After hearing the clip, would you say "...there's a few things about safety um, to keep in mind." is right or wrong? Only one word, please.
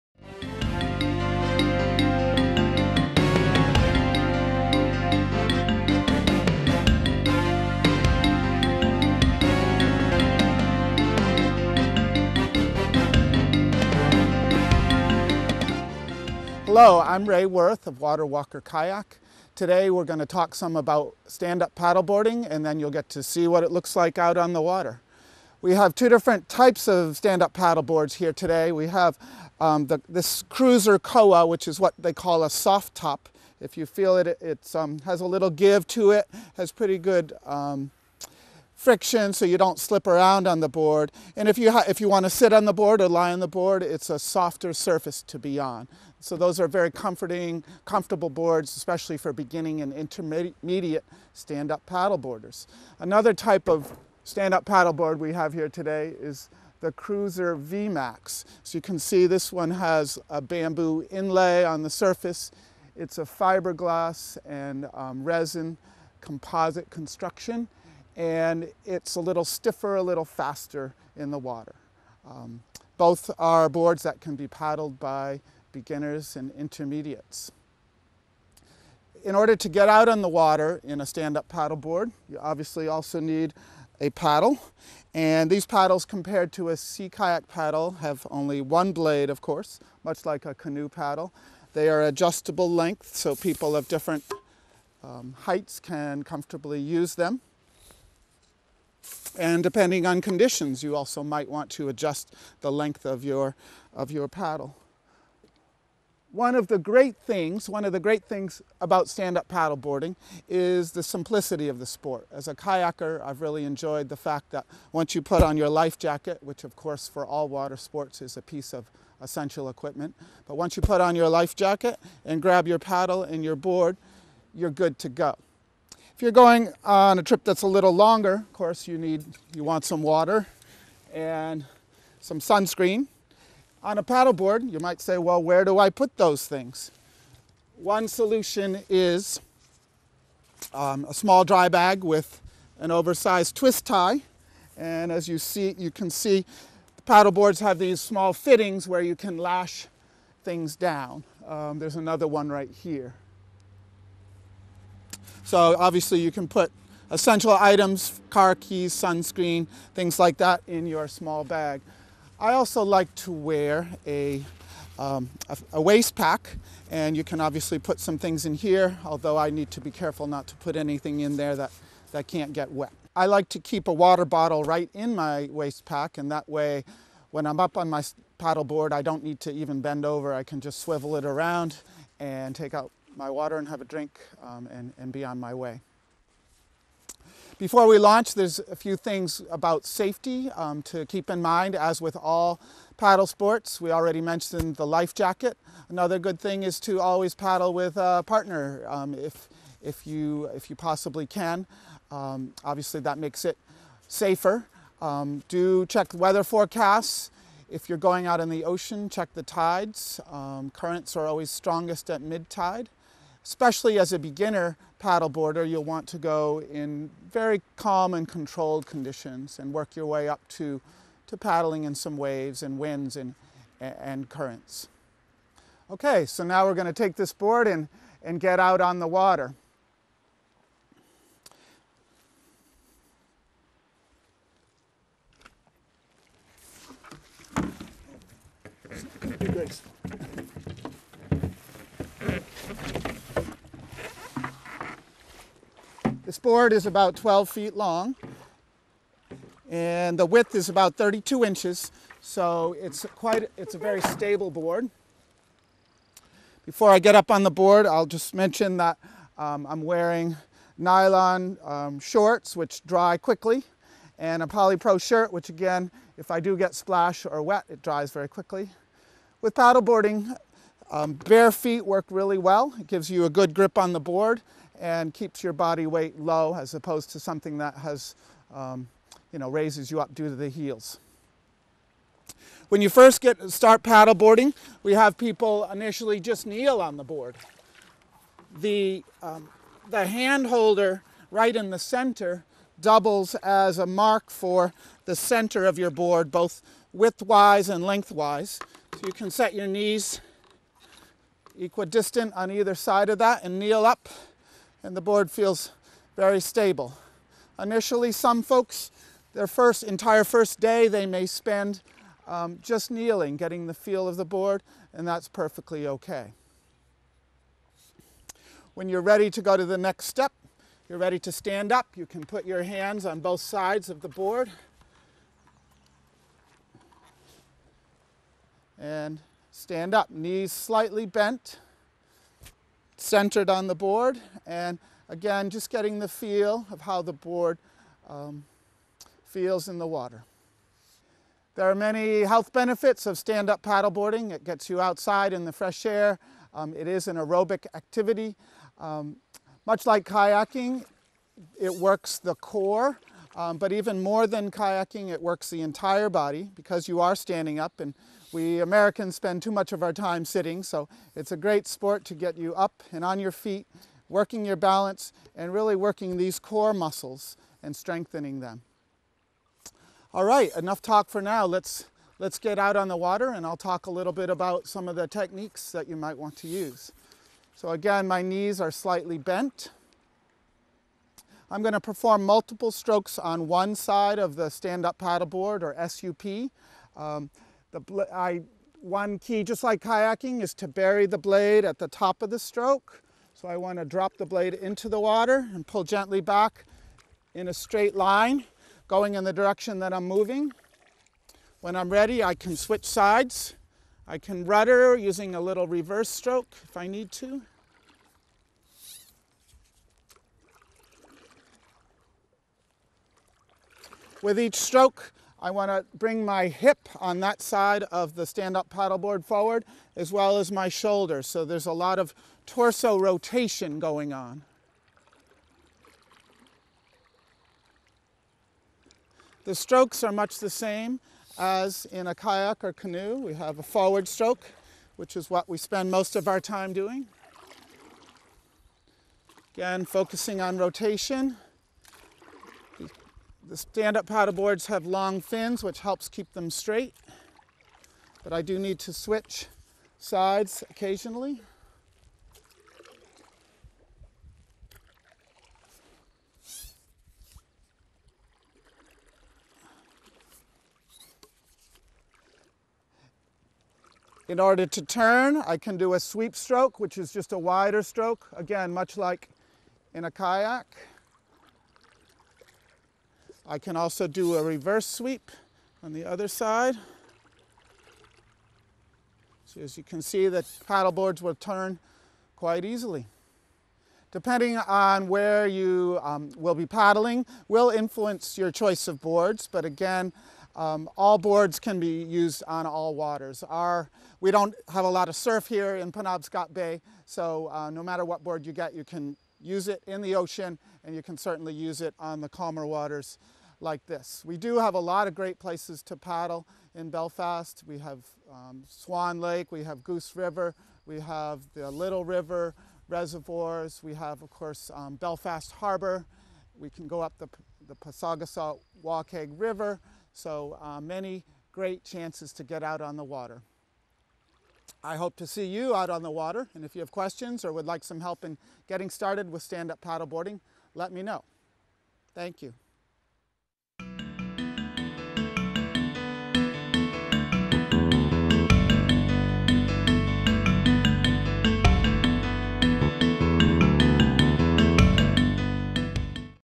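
right.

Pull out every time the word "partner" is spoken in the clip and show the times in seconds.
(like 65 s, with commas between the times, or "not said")
198 s.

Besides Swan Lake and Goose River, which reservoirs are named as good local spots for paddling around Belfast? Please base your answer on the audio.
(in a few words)
Little River reservoirs.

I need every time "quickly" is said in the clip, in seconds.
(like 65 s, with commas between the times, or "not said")
263 s, 268 s.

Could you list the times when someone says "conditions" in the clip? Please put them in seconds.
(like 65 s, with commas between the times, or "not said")
100 s, 218 s.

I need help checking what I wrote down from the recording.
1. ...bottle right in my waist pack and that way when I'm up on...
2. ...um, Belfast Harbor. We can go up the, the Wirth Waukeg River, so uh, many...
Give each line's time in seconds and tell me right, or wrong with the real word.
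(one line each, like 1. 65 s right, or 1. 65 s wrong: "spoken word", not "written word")
1. 174 s right
2. 514 s wrong: "Pasagasaw", not "Wirth".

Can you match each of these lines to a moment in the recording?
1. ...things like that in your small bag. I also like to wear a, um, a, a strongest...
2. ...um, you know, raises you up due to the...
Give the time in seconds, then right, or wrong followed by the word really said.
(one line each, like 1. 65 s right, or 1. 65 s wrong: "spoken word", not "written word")
1. 159 s wrong: "waist", not "strongest"
2. 278 s right.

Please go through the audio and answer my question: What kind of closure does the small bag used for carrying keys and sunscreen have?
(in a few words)
An oversized twist tie.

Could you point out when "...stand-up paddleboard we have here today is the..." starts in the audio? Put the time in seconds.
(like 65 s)
54 s.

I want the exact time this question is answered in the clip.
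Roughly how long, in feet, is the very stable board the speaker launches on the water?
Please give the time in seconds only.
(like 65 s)
247 s.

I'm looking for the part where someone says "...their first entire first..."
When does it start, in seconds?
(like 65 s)
309 s.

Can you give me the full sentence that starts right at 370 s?
All right, enough talk for now.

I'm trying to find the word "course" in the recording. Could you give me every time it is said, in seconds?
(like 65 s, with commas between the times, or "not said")
89 s, 116 s, 128 s, 514 s.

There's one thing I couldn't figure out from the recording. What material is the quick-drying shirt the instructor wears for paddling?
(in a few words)
Polypro.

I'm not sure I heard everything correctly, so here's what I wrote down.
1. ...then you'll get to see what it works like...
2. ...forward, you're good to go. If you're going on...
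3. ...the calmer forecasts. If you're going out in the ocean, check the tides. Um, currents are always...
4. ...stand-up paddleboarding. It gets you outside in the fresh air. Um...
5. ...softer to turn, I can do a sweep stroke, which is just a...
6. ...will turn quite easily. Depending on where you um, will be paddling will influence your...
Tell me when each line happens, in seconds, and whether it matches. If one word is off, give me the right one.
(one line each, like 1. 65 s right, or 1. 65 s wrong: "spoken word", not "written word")
1. 22 s wrong: "looks", not "works"
2. 123 s wrong: "board", not "forward"
3. 206 s wrong: "weather", not "calmer"
4. 343 s right
5. 464 s wrong: "order", not "softer"
6. 481 s right.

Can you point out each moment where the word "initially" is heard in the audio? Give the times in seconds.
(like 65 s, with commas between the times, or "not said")
285 s, 307 s.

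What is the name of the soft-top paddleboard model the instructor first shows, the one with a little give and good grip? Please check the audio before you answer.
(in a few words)
Cruiser Koa.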